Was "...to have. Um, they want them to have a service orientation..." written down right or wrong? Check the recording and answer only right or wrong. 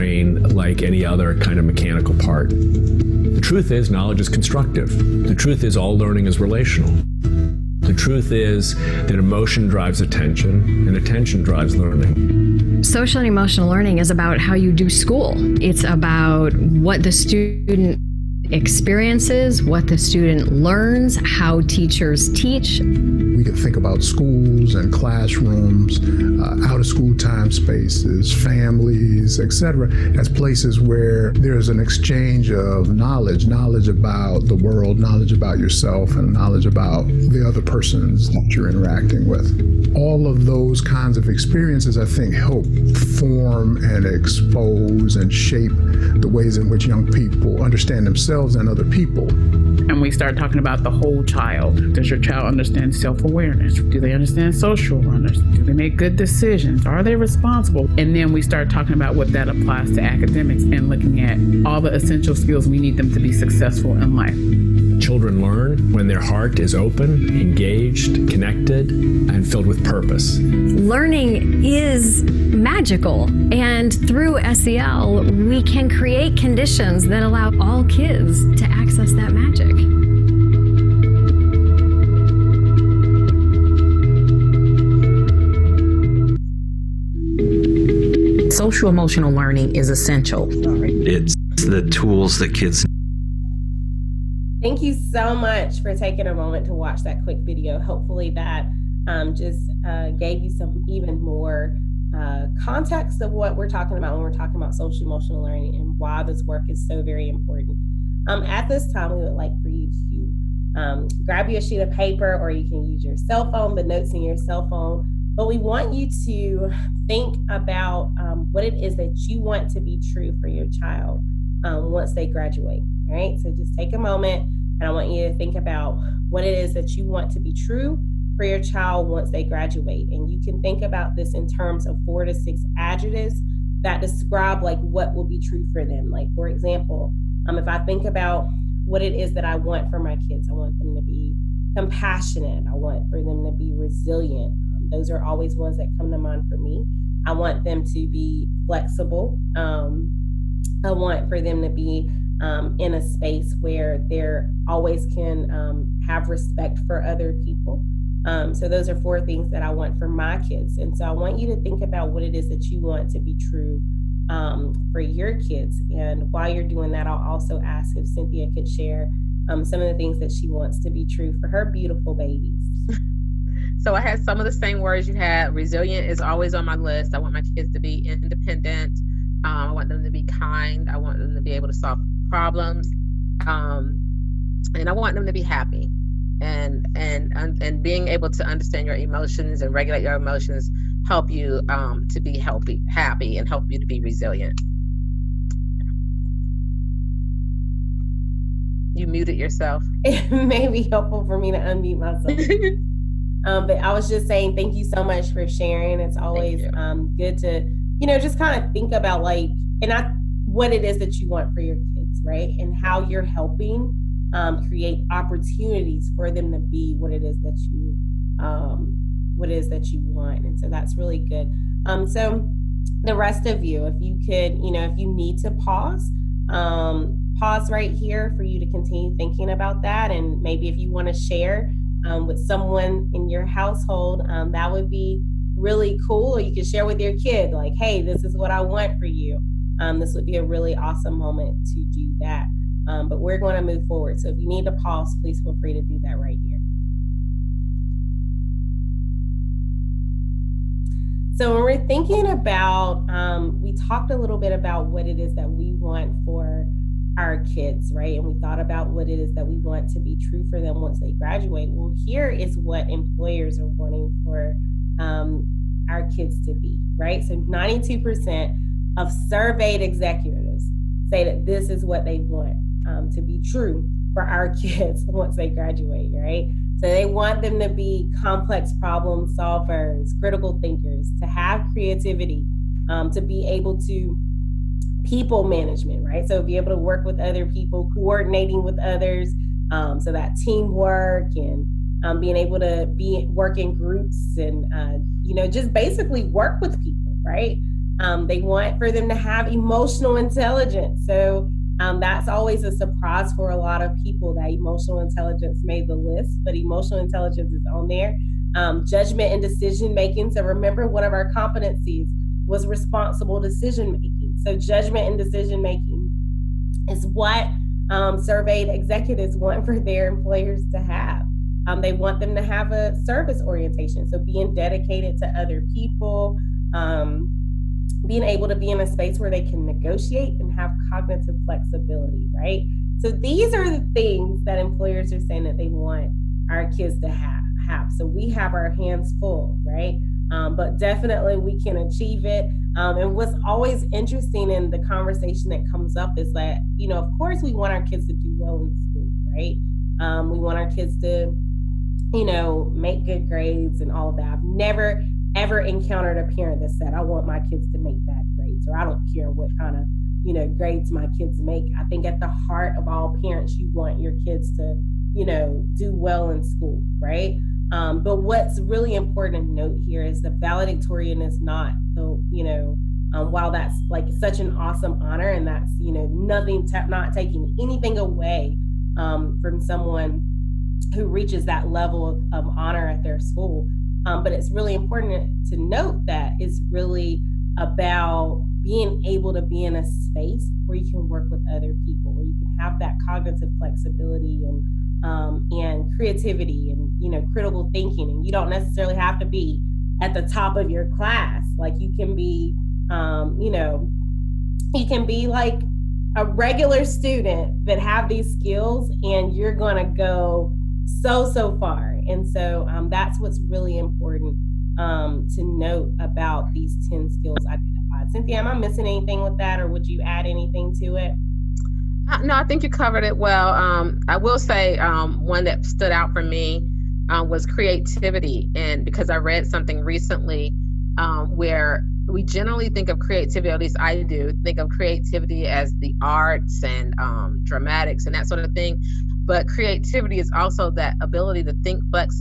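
right.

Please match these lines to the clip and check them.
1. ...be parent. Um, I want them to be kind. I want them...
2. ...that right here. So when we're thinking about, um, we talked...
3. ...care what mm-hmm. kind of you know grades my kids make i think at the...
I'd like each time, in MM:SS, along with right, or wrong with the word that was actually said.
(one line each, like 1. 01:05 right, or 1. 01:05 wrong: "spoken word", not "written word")
1. 02:57 wrong: "independent", not "parent"
2. 04:06 right
3. 05:59 right.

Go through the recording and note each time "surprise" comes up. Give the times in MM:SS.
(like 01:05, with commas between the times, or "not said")
05:02.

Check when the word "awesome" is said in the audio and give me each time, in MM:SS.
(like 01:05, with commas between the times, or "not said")
04:00, 06:14.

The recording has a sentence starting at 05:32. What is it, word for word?
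So these are the things that employers are saying that they want our kids to have.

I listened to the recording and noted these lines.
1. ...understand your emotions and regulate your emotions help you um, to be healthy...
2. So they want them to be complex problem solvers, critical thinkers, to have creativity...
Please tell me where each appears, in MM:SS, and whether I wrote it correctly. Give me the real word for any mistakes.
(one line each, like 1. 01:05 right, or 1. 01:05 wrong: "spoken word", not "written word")
1. 03:08 right
2. 04:36 right.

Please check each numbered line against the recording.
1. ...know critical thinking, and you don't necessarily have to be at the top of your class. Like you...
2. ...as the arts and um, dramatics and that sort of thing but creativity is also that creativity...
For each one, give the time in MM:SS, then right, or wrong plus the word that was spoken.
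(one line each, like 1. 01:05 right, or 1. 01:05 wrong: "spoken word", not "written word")
1. 06:37 right
2. 07:15 wrong: "ability", not "creativity".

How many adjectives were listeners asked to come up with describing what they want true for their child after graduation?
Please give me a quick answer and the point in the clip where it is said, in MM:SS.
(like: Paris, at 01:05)
4 to 6, at 02:12.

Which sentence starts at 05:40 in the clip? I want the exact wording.
Um, but definitely we can achieve it.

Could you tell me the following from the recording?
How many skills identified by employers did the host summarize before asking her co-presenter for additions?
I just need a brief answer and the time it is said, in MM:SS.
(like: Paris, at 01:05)
10, at 06:56.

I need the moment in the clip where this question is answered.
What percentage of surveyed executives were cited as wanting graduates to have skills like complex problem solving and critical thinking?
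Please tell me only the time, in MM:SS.
04:27.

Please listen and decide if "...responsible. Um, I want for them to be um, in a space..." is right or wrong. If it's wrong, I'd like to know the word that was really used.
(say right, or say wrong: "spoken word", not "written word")
wrong: "flexible", not "responsible".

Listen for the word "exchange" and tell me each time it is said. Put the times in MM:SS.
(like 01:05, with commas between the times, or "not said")
00:31.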